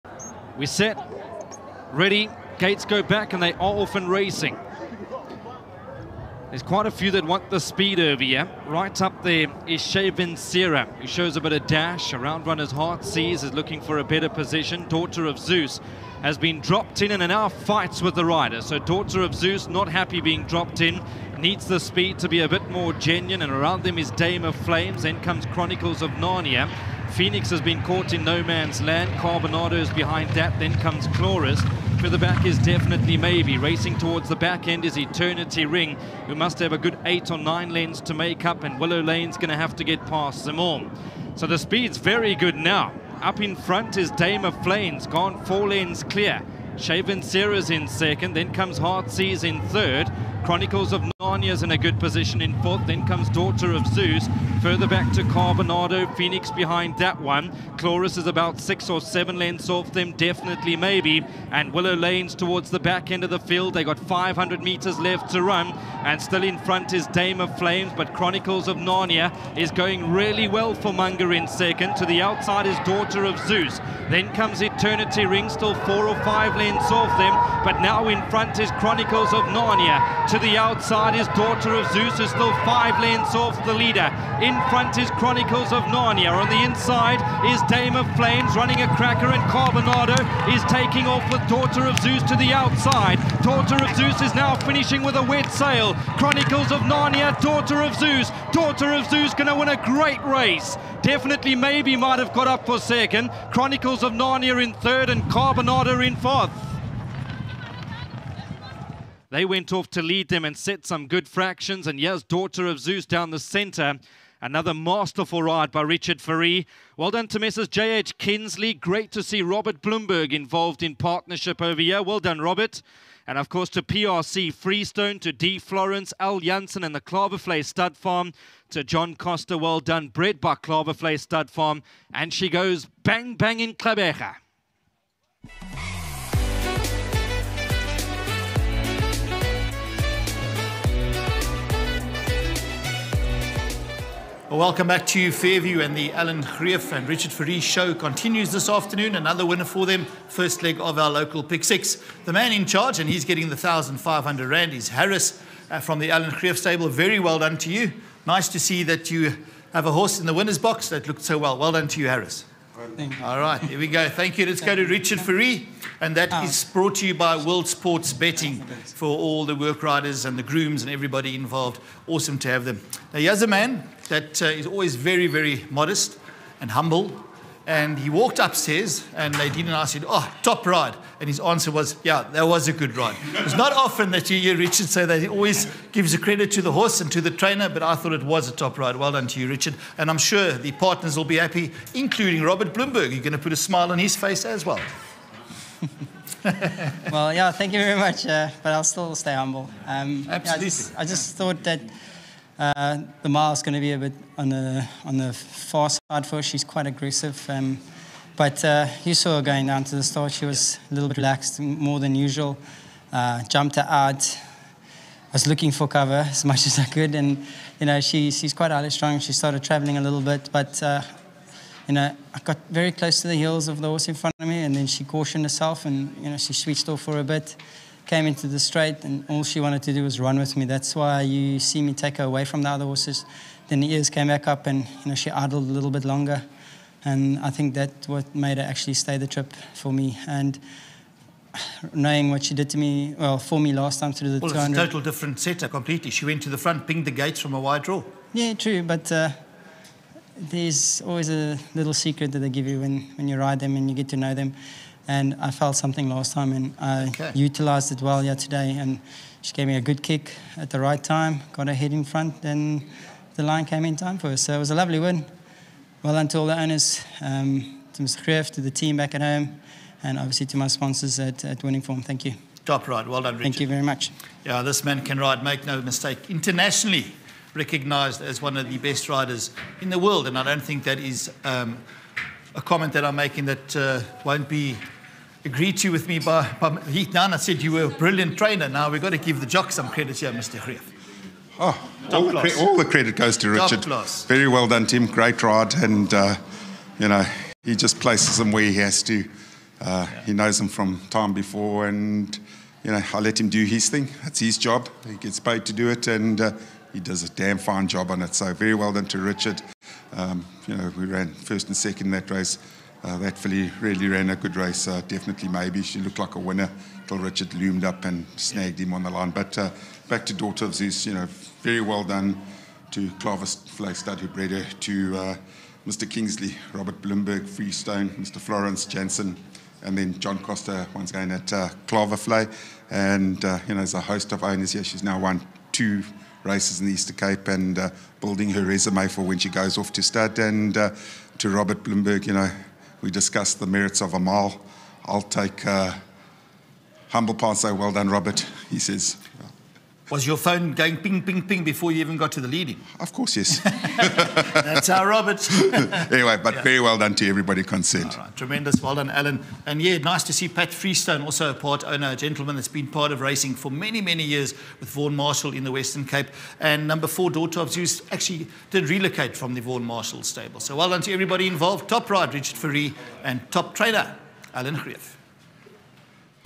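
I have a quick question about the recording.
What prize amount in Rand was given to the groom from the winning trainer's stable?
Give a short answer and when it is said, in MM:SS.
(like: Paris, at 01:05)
1,500 Rand, at 02:33.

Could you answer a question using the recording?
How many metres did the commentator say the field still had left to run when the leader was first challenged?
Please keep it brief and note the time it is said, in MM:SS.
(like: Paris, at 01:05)
500, at 01:03.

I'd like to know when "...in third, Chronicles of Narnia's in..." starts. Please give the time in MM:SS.
00:49.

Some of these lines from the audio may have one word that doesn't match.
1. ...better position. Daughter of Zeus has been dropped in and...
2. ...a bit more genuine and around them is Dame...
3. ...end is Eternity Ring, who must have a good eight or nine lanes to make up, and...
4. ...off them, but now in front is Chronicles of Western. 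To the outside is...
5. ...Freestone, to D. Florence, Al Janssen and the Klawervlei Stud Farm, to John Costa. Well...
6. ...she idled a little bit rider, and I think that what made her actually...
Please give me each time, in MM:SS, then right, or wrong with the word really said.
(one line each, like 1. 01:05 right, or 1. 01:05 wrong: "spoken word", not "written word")
1. 00:14 right
2. 00:22 right
3. 00:34 right
4. 01:17 wrong: "Narnia", not "Western"
5. 02:04 right
6. 03:55 wrong: "longer", not "rider".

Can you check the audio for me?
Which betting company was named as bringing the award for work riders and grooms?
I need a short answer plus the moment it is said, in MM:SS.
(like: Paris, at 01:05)
World Sports Betting, at 02:47.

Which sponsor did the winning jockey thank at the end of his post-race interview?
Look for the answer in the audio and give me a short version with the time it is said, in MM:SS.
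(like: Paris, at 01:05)
Winning Form, at 04:31.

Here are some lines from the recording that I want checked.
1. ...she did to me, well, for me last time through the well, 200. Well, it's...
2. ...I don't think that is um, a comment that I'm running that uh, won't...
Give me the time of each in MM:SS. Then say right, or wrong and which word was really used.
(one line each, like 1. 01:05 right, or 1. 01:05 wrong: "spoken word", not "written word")
1. 04:02 right
2. 04:40 wrong: "making", not "running".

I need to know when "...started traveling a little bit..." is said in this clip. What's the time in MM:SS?
03:39.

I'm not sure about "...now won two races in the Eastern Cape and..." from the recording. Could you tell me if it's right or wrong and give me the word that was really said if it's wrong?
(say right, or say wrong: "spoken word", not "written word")
right.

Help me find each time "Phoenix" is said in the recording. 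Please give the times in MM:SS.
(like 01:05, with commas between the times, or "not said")
00:27, 00:56.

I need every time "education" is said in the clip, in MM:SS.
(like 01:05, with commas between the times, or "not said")
not said.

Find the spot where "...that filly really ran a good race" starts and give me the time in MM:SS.
05:13.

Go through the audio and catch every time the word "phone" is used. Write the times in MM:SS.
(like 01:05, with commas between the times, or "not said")
05:50.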